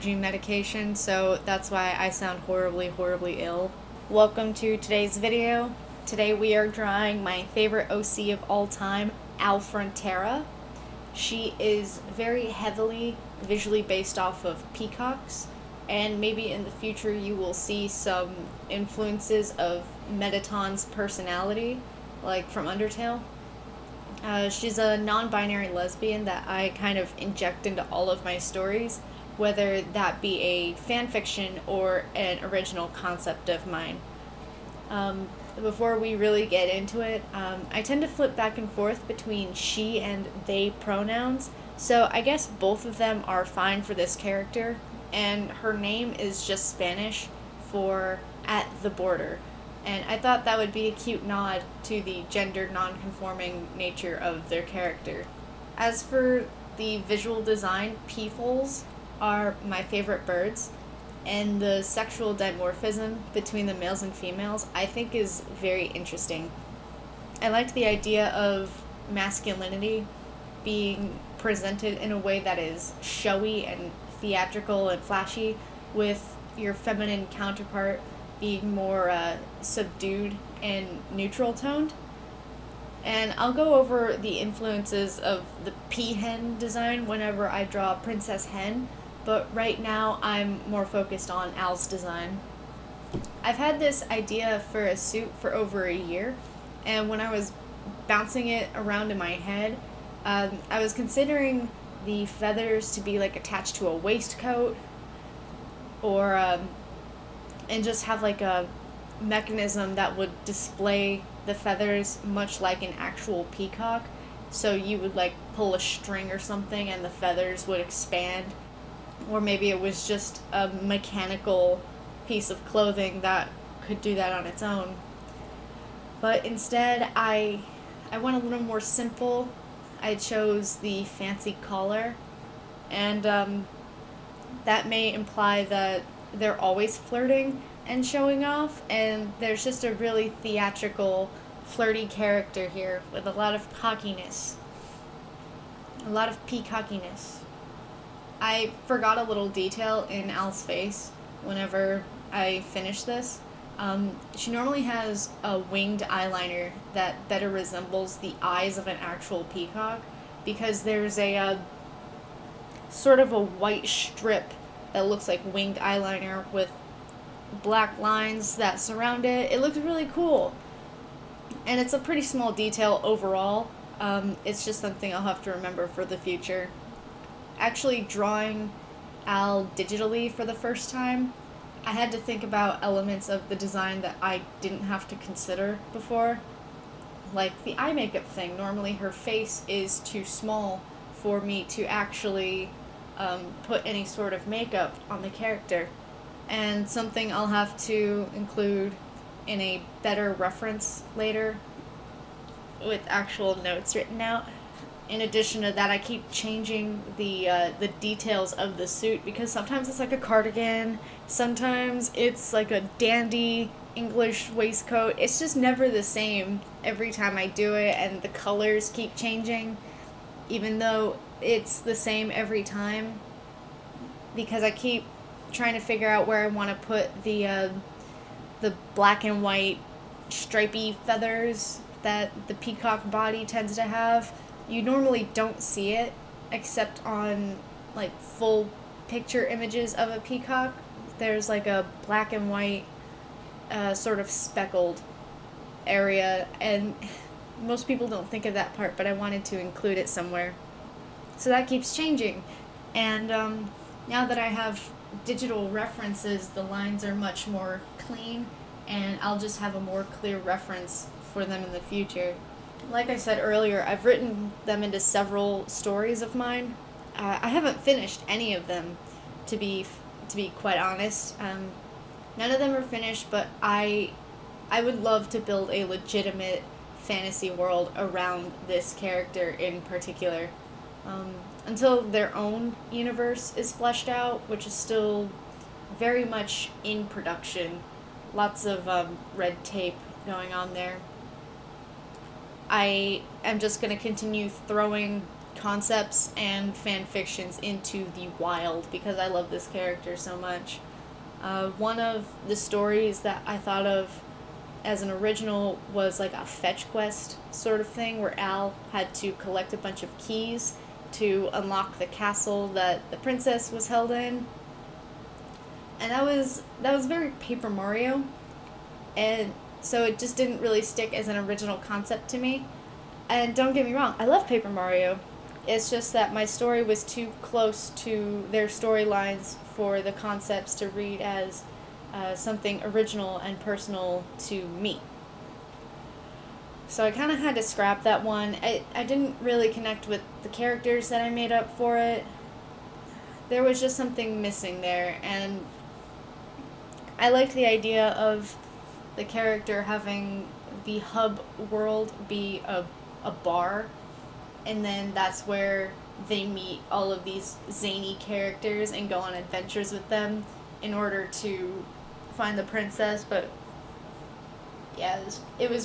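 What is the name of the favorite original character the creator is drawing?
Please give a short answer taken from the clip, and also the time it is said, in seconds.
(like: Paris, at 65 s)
Al Frontera, at 9 s.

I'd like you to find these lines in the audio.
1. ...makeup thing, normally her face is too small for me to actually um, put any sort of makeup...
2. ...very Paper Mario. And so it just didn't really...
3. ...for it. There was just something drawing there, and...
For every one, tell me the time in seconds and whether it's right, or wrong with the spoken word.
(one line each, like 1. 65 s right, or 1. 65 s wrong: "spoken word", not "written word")
1. 187 s right
2. 317 s right
3. 341 s wrong: "missing", not "drawing".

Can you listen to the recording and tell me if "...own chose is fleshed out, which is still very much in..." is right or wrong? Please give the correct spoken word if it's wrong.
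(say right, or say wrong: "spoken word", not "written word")
wrong: "universe", not "chose".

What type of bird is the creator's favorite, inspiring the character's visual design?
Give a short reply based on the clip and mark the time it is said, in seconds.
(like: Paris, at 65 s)
Peafowl, at 58 s.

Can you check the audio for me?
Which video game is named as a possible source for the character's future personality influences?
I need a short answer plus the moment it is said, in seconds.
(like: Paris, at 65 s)
Undertale, at 22 s.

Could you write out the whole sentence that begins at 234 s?
You normally don't see it except on like full picture images of a peacock.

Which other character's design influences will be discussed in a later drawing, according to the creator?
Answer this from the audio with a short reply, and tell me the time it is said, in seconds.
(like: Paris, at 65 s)
Princess Hen, at 87 s.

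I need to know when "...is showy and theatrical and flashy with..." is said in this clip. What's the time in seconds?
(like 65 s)
72 s.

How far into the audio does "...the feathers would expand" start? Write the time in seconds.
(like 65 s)
117 s.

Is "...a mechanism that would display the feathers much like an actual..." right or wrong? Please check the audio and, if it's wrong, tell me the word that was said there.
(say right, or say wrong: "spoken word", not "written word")
right.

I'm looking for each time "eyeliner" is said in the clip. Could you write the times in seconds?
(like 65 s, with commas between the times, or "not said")
156 s, 165 s.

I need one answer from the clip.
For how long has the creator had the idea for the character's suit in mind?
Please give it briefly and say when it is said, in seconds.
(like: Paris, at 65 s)
Over a year, at 95 s.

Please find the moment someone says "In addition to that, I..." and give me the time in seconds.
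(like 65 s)
205 s.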